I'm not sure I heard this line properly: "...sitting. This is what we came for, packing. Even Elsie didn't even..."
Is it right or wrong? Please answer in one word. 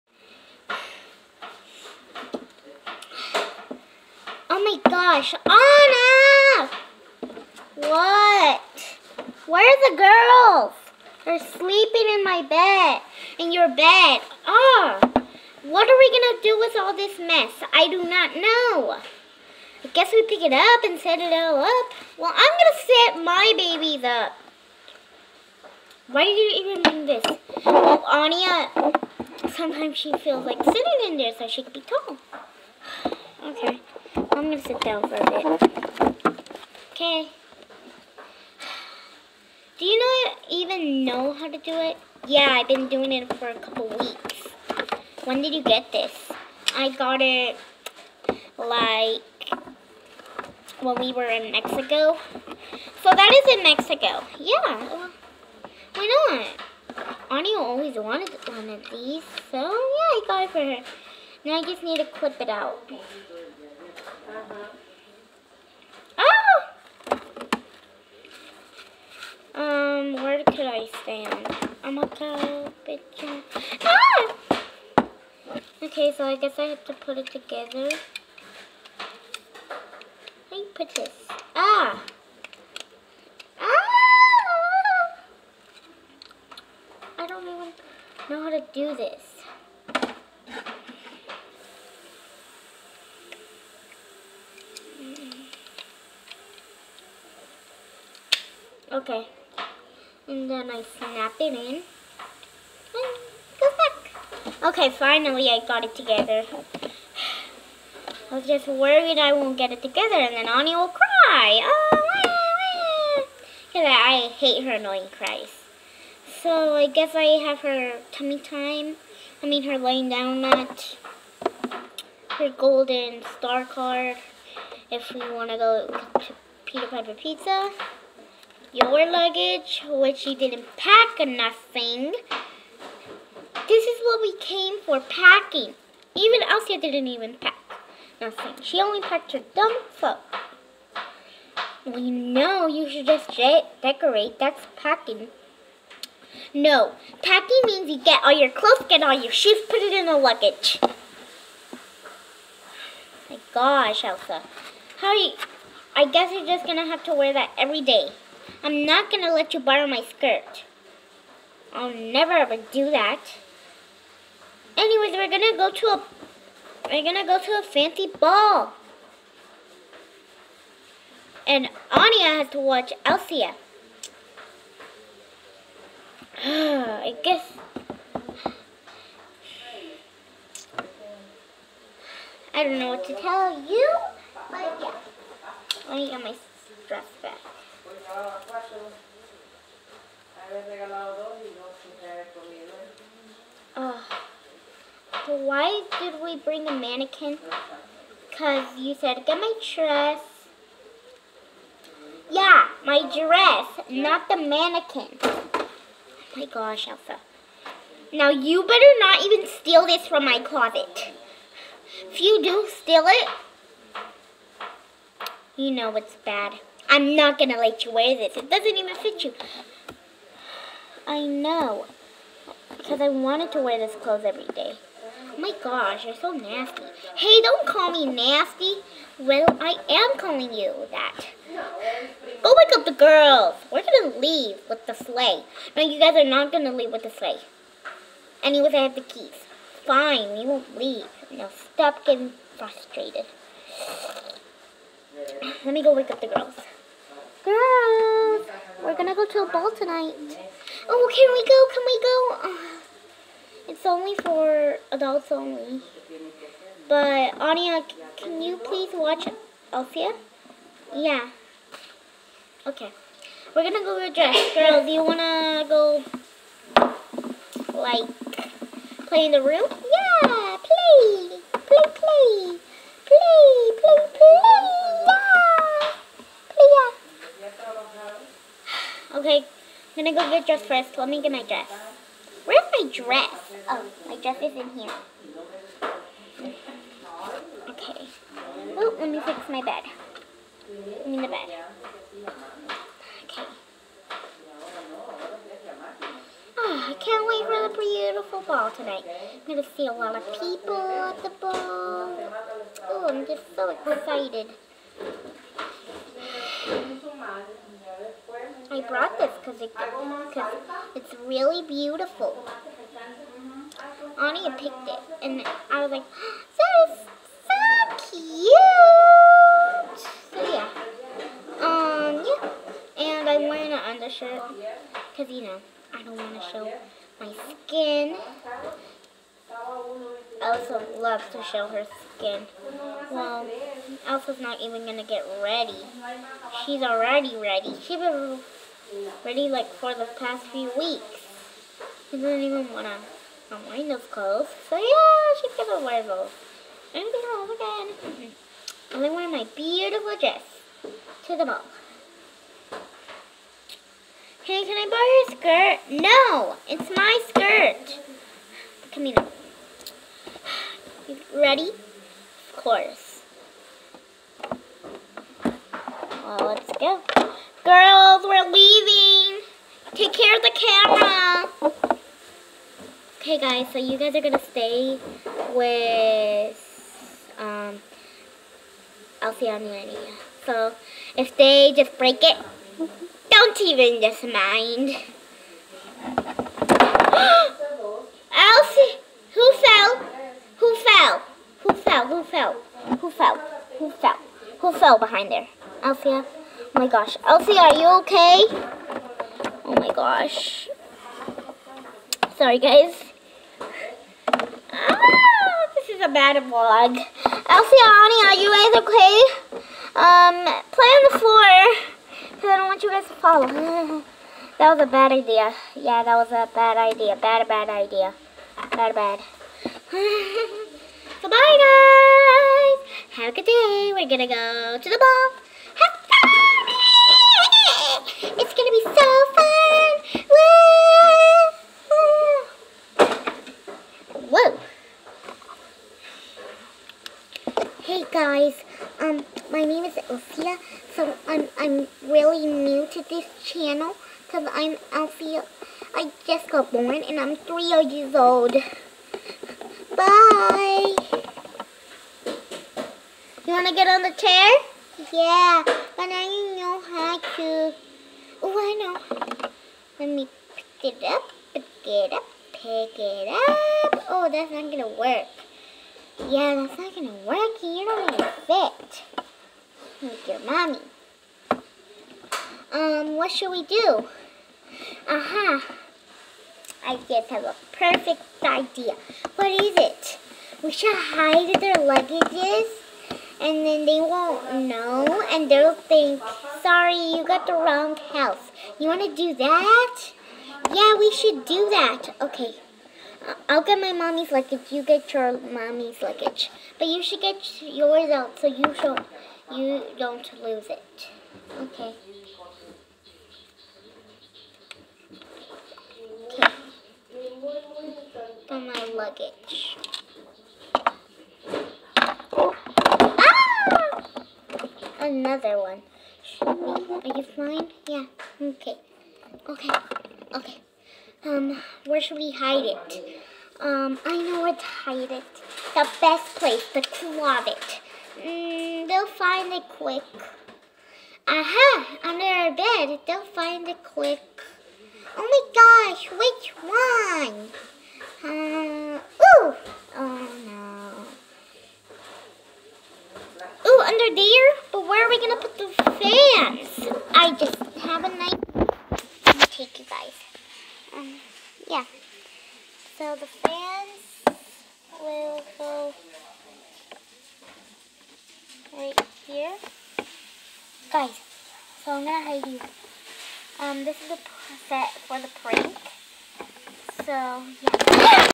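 wrong.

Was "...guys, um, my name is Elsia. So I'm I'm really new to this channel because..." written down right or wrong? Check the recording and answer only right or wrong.
right.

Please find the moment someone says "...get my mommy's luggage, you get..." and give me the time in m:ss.
8:13.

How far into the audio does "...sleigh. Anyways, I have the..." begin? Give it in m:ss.
3:57.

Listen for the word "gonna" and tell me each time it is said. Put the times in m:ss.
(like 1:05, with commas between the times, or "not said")
0:34, 4:08, 4:23, 4:40, 7:04, 7:08.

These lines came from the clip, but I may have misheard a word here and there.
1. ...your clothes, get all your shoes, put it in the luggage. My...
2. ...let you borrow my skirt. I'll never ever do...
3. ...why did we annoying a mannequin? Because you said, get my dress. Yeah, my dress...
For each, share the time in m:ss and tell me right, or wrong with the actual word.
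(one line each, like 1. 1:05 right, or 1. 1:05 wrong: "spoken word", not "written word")
1. 2:28 right
2. 2:39 right
3. 3:15 wrong: "bring", not "annoying".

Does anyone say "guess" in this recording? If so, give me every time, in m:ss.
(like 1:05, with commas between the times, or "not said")
0:19, 1:16, 1:56, 2:36, 2:57.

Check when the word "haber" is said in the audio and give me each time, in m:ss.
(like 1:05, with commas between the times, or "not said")
3:12.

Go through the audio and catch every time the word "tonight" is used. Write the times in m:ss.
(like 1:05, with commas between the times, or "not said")
4:09, 4:58.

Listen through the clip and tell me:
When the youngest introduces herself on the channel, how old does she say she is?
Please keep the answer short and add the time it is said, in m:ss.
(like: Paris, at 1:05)
3, at 7:27.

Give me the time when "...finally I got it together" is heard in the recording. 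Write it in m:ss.
1:44.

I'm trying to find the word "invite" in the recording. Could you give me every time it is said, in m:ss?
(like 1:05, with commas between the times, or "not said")
not said.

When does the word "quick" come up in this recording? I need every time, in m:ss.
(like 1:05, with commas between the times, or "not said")
8:49, 8:53.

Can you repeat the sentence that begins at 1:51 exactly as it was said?
Oh, Because I hate her annoying cries.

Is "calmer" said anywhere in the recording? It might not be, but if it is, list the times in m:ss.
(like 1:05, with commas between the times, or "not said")
not said.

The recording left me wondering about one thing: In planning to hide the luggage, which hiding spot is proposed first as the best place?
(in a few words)
the closet.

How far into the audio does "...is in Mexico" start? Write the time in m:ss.
0:53.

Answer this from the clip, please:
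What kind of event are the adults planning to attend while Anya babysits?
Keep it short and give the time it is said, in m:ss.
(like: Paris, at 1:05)
a fancy ball, at 2:47.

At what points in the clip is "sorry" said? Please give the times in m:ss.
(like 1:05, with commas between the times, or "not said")
6:42, 8:06.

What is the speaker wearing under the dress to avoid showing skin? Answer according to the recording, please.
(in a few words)
an undershirt.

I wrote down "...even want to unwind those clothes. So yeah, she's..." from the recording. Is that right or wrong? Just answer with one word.
right.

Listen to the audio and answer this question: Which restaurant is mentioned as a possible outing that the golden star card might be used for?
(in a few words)
Peter Piper Pizza.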